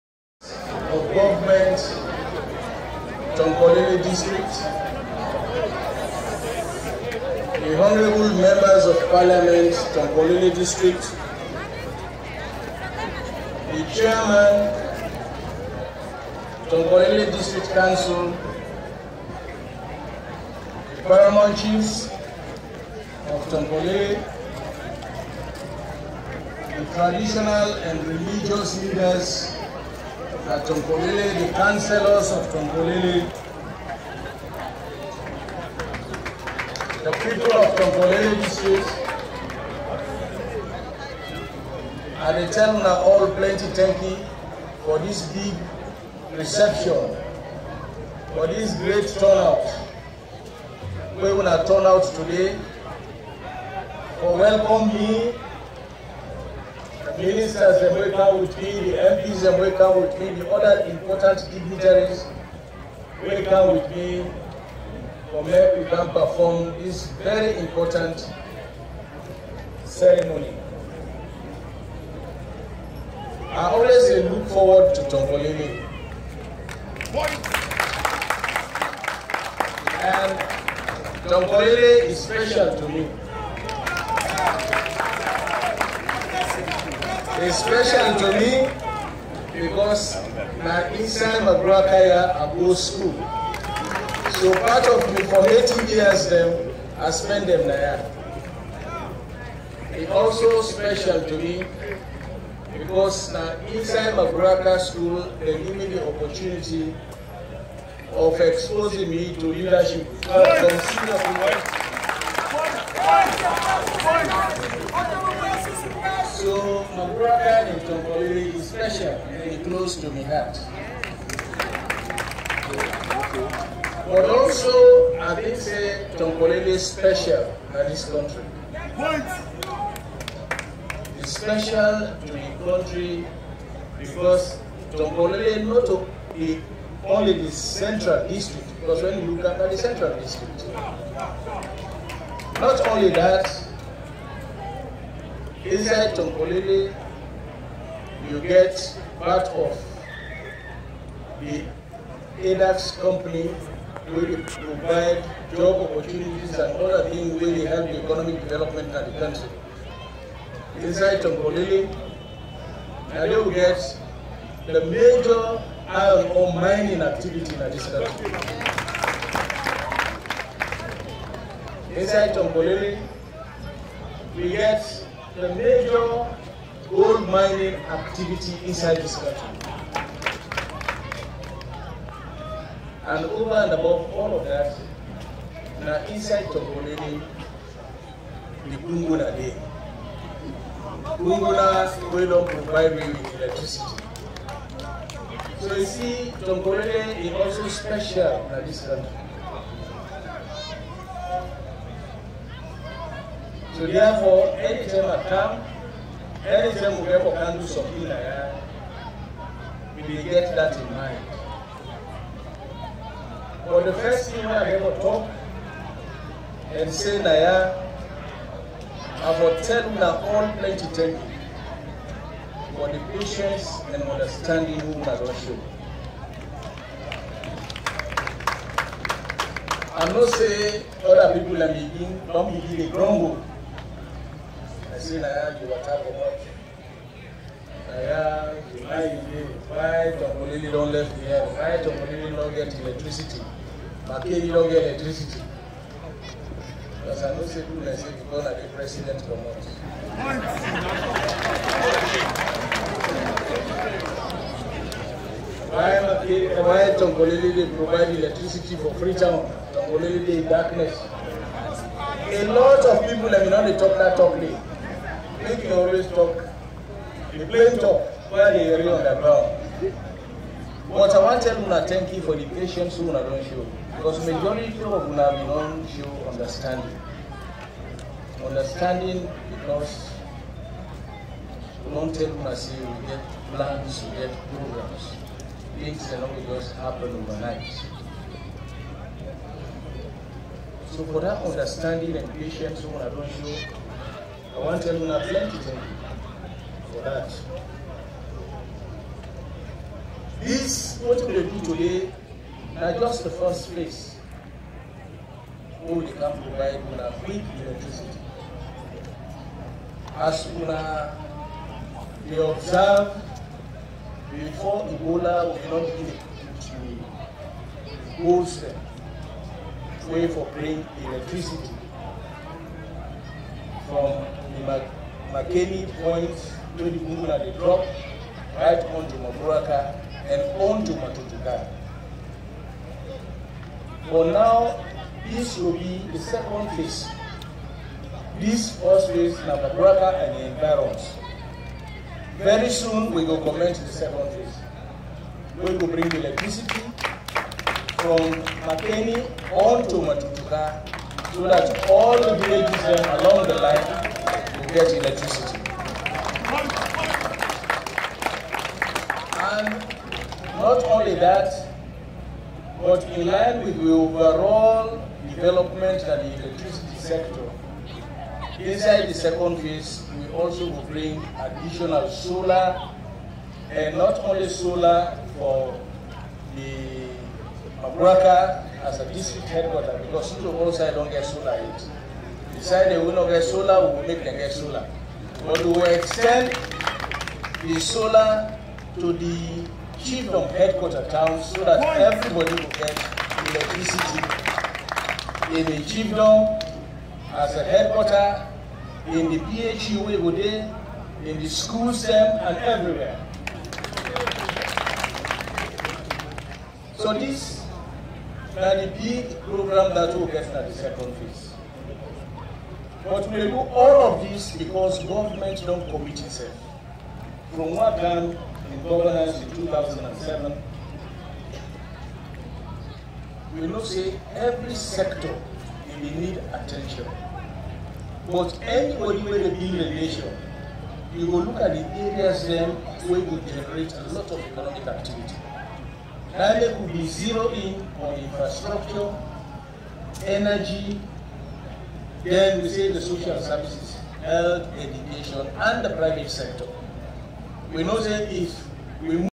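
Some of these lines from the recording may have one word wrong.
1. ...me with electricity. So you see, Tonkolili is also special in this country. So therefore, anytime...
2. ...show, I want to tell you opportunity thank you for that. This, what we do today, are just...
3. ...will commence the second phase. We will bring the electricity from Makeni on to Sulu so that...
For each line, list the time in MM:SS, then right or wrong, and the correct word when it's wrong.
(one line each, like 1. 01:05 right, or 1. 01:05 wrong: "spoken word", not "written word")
1. 03:12 right
2. 04:53 wrong: "plenty", not "opportunity"
3. 05:43 wrong: "Matotoka", not "Sulu".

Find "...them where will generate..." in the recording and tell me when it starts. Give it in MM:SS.
07:12.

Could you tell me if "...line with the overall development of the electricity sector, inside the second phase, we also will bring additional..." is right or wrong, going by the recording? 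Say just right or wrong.
right.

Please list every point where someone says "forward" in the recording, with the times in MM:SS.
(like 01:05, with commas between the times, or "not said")
01:14.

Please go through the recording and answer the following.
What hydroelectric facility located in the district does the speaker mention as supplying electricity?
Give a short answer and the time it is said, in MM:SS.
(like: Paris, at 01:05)
Bumbuna Dam, at 03:08.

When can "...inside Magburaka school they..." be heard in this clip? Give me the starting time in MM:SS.
01:43.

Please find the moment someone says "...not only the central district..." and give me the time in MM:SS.
02:15.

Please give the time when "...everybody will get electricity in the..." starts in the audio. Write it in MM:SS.
06:31.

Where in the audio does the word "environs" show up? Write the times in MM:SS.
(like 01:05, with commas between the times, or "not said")
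05:40.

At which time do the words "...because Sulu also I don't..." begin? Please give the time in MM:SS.
06:20.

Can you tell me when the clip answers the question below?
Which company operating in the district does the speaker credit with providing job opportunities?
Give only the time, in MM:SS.
02:32.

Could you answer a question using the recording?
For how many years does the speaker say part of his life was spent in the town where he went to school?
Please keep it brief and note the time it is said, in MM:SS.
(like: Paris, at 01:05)
18, at 01:35.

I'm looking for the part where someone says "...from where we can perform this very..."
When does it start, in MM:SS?
01:05.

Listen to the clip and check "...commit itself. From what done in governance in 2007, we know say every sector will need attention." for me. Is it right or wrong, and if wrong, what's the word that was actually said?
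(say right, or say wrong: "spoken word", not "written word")
right.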